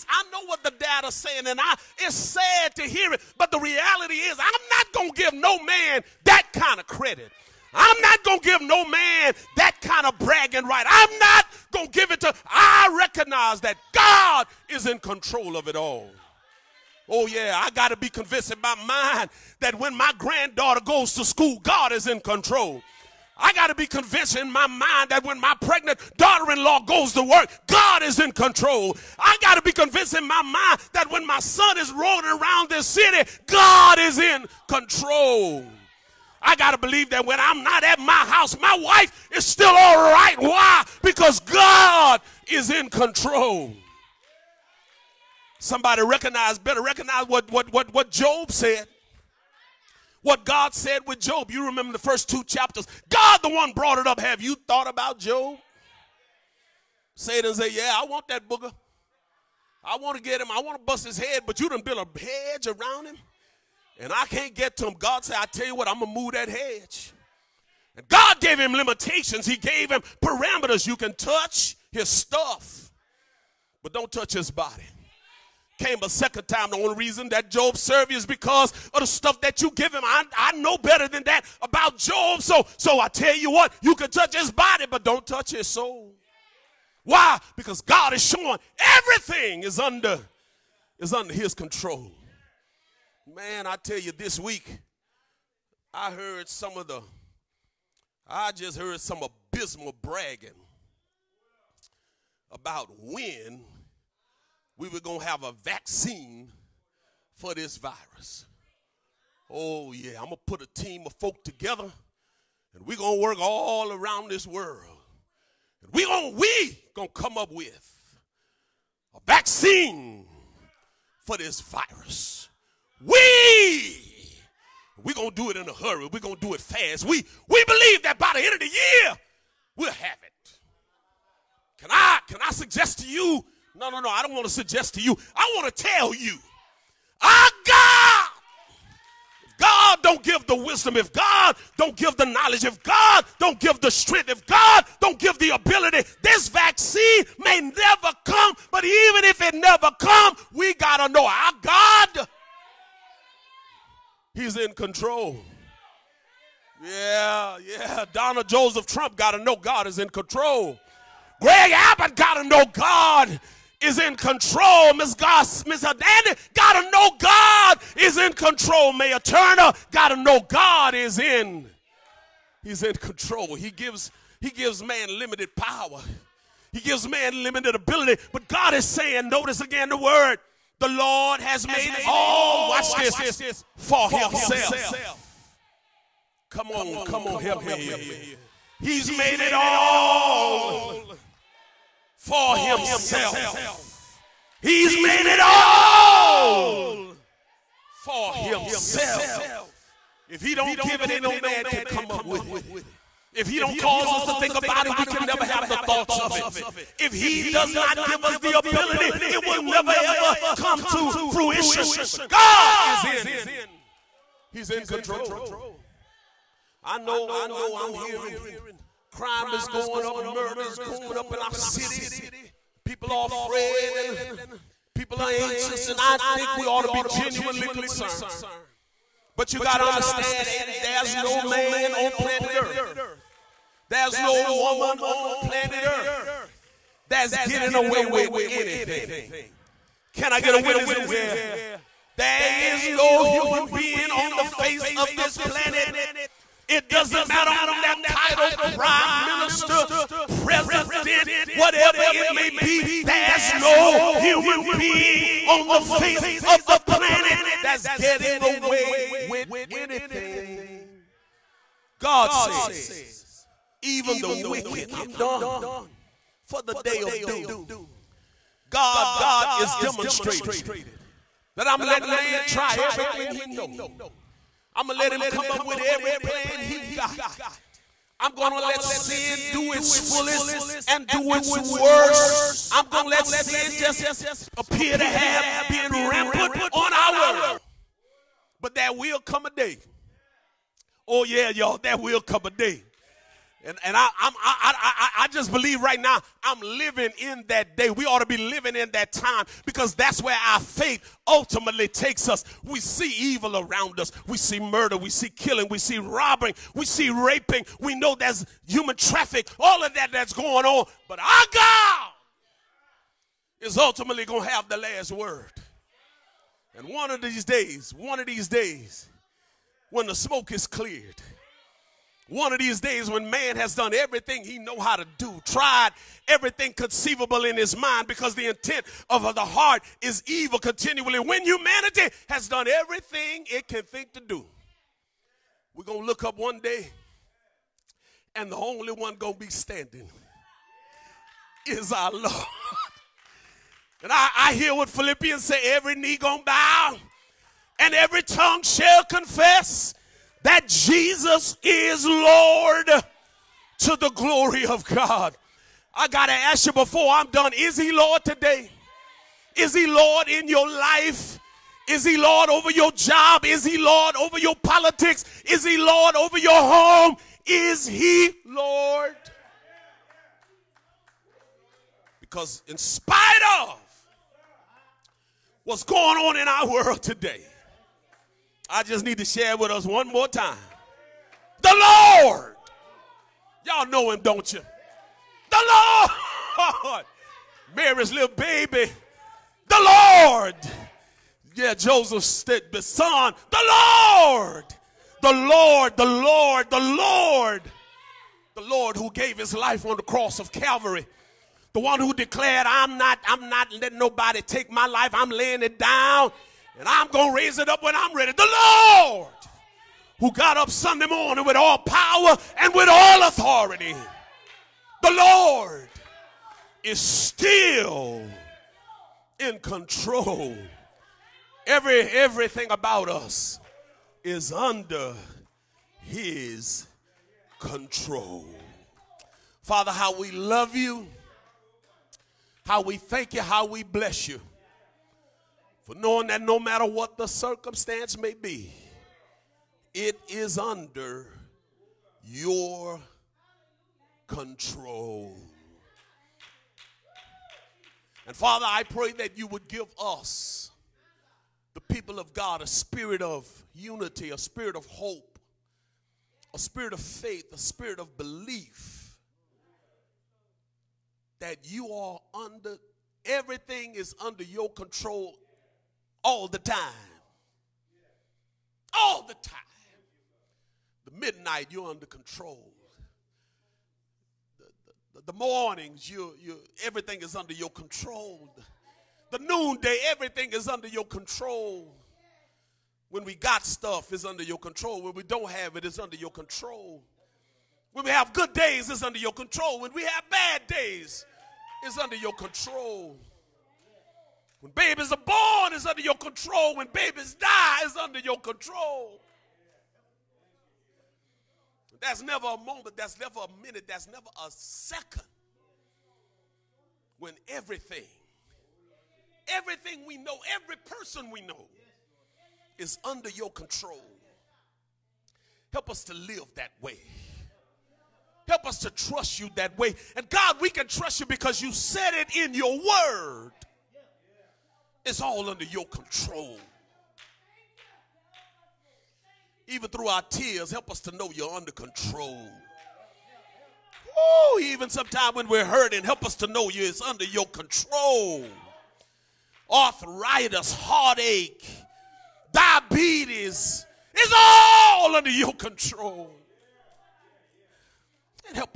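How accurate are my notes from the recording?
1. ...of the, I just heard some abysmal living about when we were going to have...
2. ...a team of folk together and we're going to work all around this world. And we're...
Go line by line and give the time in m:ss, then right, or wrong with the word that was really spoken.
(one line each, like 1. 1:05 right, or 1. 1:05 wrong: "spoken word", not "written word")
1. 1:36 wrong: "bragging", not "living"
2. 1:50 right.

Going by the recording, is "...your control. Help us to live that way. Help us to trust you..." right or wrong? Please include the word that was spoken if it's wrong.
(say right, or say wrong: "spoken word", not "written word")
right.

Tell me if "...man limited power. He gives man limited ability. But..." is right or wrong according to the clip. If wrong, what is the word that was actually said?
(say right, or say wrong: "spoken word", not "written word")
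right.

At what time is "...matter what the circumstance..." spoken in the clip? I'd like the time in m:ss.
7:16.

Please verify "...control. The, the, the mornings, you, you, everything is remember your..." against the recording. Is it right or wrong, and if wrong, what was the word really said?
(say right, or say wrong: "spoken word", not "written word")
wrong: "under", not "remember".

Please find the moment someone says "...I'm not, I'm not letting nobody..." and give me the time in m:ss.
6:42.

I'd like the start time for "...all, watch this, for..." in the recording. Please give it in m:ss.
3:02.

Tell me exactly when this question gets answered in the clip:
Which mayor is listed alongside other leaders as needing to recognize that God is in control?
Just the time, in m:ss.
2:48.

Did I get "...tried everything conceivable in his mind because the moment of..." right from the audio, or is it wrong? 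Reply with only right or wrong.
wrong.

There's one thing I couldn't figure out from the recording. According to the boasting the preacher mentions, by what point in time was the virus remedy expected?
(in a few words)
end of the year.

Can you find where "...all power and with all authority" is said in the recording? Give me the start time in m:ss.
6:51.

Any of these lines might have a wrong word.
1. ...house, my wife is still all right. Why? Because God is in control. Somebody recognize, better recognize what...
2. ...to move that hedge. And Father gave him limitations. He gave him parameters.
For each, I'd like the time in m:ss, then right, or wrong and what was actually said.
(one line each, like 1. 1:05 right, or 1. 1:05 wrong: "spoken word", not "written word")
1. 0:38 right
2. 1:06 wrong: "God", not "Father".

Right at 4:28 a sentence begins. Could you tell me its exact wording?
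God, God is demonstrated that I'm letting man try everything he know.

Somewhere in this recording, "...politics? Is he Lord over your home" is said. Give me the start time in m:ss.
6:04.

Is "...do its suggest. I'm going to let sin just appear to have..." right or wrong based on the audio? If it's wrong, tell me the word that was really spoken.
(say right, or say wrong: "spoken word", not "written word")
wrong: "worst", not "suggest".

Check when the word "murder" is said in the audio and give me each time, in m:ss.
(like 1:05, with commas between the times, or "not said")
3:40, 5:04.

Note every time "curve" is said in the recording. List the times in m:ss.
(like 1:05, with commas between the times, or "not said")
not said.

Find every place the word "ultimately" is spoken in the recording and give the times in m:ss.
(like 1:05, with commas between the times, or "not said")
5:01, 5:13.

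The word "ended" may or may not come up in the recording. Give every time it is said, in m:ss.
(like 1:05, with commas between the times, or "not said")
not said.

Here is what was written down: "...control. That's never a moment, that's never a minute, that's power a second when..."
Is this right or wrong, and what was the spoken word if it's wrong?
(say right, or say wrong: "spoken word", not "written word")
wrong: "never", not "power".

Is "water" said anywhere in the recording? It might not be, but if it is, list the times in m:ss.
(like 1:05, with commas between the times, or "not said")
not said.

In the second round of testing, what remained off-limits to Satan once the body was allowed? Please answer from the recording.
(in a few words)
his soul.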